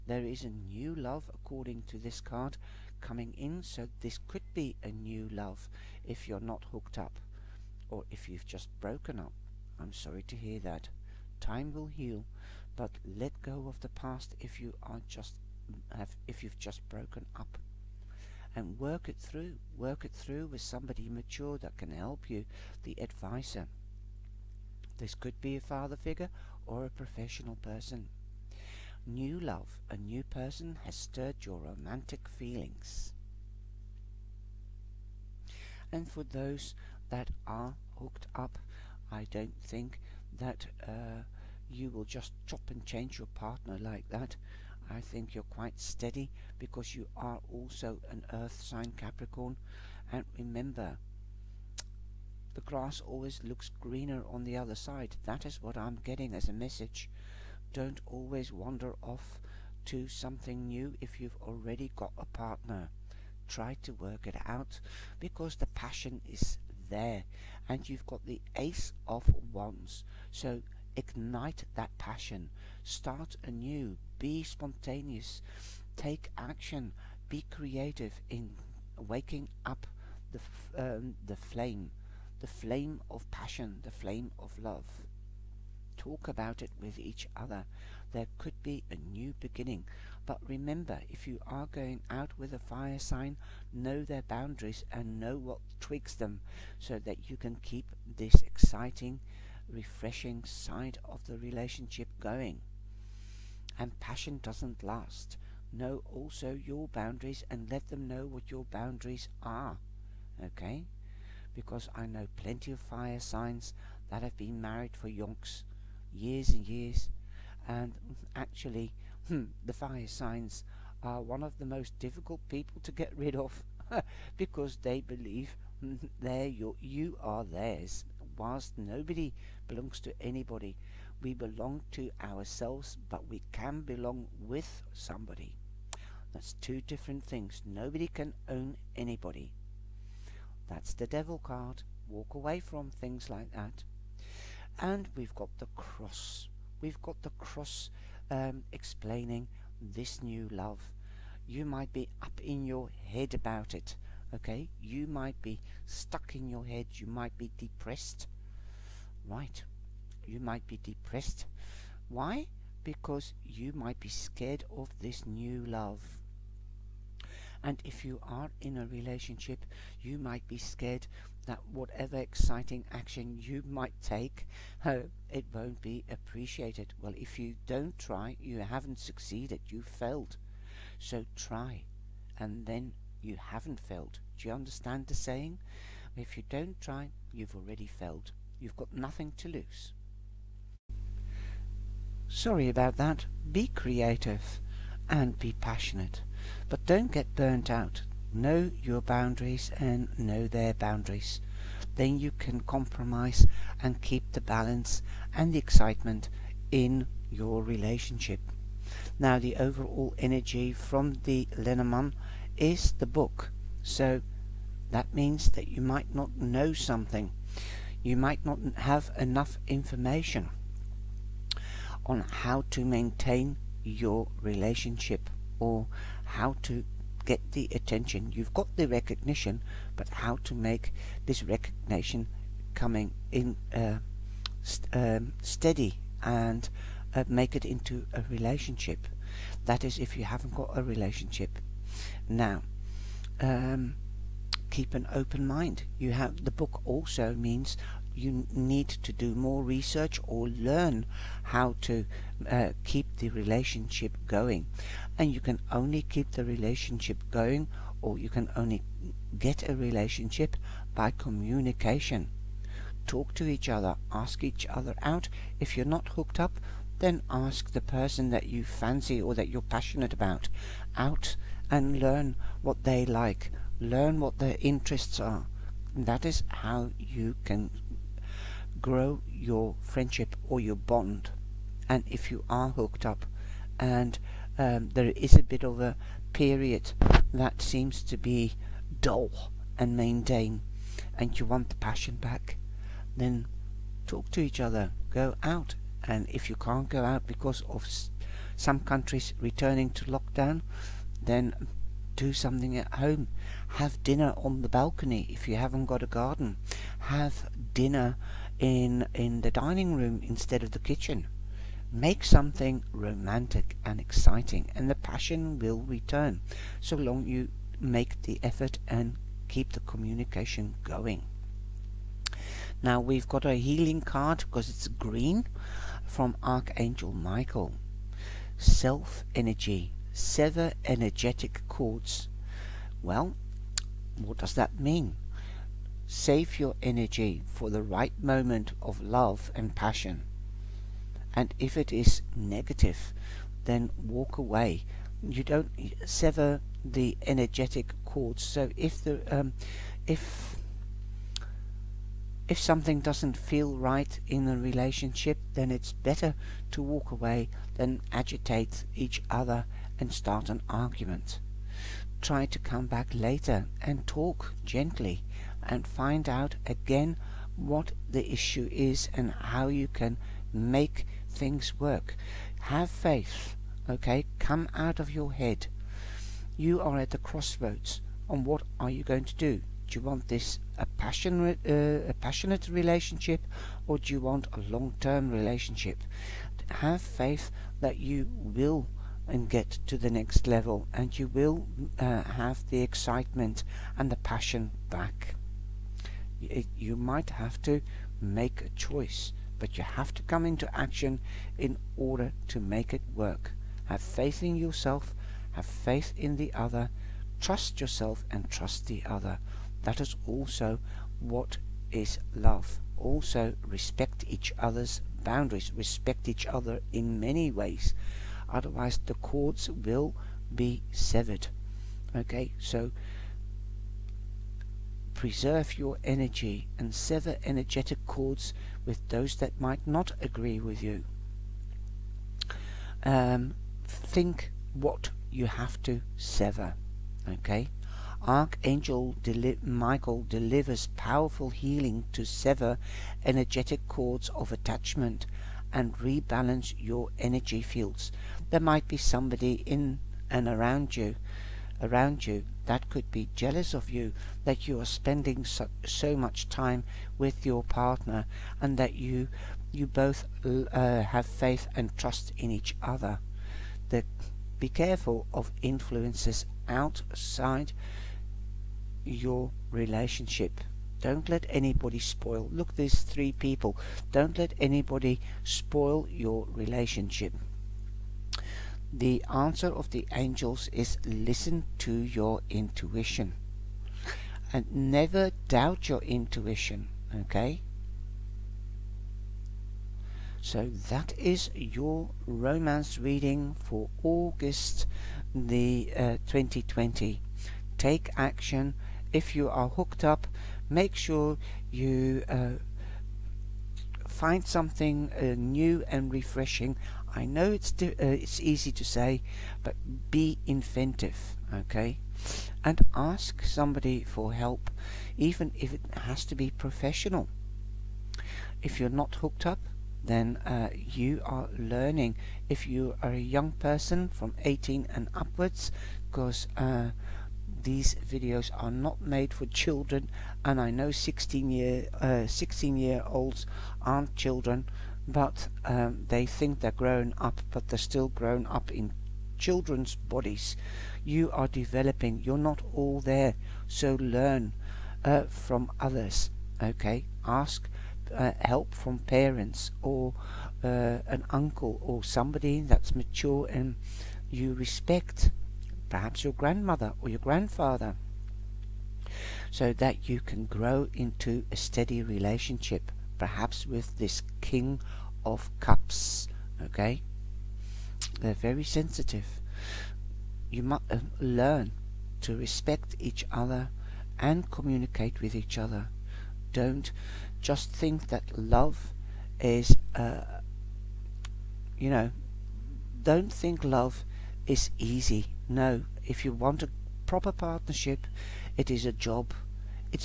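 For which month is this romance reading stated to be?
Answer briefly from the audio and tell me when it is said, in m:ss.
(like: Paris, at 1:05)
August, at 8:14.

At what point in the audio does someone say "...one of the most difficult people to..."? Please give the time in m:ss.
2:01.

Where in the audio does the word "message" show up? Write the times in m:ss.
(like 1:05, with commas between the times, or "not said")
0:56.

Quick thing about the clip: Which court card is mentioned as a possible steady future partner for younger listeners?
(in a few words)
King of Cups.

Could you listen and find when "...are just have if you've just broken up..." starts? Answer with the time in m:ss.
0:14.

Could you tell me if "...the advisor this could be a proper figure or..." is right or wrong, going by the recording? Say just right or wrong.
wrong.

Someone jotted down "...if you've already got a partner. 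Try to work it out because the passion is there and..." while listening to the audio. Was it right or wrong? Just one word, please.
right.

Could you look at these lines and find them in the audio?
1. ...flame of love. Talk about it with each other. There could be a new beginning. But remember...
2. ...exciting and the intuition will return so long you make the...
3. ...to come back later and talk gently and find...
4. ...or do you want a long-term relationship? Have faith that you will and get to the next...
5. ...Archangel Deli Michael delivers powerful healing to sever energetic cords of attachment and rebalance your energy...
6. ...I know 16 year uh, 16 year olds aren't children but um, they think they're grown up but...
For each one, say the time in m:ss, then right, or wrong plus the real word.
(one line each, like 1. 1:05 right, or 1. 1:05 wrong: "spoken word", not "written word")
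1. 1:23 right
2. 5:13 wrong: "passion", not "intuition"
3. 6:02 right
4. 6:23 right
5. 7:18 right
6. 8:50 right.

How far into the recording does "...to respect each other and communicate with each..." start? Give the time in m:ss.
9:32.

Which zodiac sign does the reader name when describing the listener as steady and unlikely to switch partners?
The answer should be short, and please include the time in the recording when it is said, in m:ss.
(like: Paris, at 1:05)
Capricorn, at 0:48.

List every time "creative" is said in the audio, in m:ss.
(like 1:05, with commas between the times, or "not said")
1:17, 3:13.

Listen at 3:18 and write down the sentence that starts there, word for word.
Know your boundaries and know their boundaries.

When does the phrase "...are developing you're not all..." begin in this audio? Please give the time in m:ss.
9:01.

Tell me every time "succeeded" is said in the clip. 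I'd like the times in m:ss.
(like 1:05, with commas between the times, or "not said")
2:58.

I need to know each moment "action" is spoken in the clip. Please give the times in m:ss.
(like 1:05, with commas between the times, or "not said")
1:16, 2:52, 6:40, 8:18.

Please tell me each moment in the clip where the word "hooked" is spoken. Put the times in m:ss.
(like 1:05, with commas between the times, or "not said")
0:06, 0:37, 4:26, 4:42, 8:19, 8:39.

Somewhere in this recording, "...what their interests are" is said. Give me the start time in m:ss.
4:34.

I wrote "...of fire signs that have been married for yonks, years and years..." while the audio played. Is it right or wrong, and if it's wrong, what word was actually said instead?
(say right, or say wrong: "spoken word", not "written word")
right.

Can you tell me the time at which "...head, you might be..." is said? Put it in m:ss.
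2:36.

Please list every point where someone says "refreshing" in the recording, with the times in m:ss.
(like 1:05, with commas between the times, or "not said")
1:39, 8:26.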